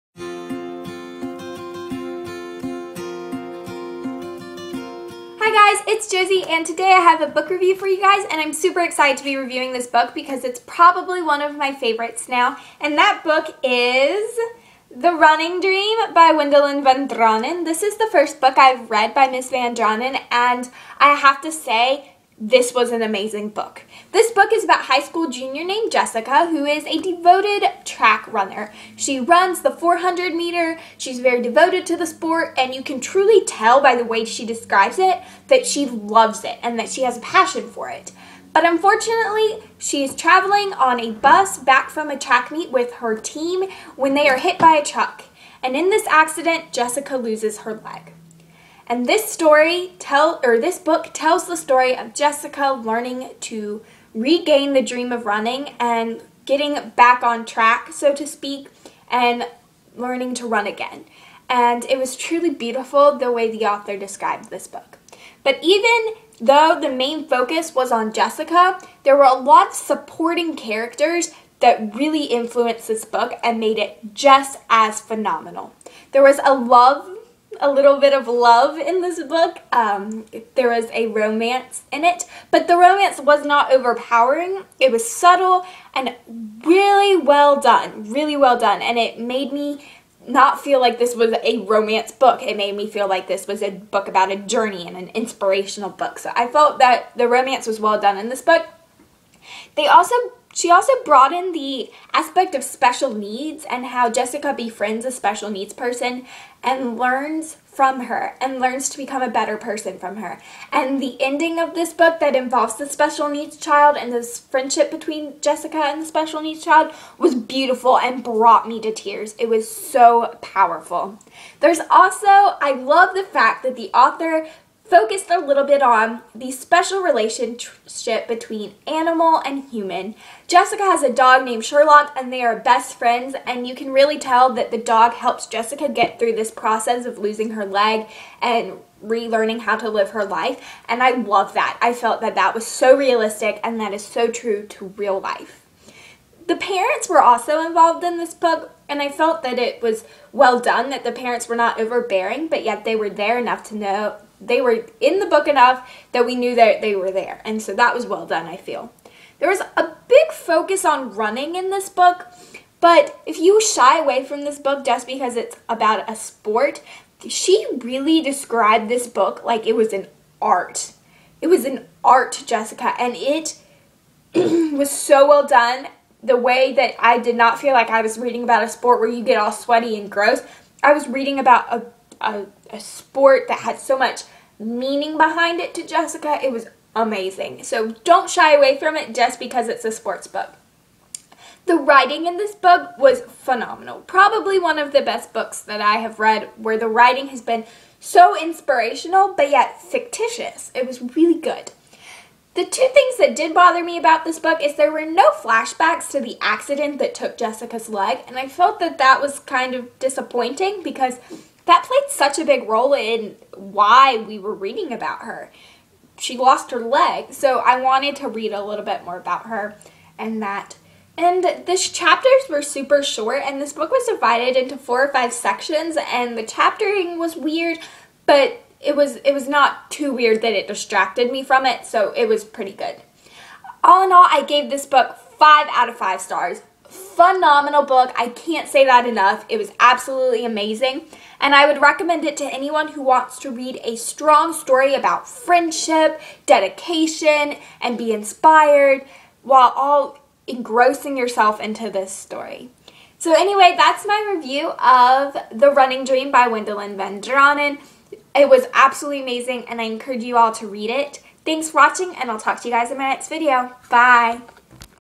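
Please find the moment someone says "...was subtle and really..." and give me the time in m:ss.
1:24.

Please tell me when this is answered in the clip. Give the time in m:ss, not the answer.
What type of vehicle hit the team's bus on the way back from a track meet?
0:44.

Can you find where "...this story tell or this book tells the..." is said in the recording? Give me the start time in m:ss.
0:49.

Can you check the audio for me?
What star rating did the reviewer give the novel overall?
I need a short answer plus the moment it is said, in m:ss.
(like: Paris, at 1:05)
5 out of 5, at 3:55.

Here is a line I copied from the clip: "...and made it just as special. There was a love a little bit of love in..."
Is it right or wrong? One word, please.
wrong.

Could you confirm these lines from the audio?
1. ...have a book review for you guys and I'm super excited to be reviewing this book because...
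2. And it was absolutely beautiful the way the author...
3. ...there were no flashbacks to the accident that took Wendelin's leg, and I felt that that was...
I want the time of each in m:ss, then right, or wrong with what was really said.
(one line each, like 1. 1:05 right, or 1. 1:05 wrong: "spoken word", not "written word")
1. 0:06 right
2. 1:01 wrong: "truly", not "absolutely"
3. 3:24 wrong: "Jessica", not "Wendelin".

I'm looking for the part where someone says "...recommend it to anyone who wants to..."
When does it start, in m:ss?
4:01.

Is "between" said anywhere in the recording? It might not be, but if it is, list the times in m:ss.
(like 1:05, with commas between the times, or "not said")
1:54, 2:08.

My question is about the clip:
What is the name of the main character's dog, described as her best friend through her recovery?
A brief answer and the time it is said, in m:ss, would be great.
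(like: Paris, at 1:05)
Sherlock, at 2:11.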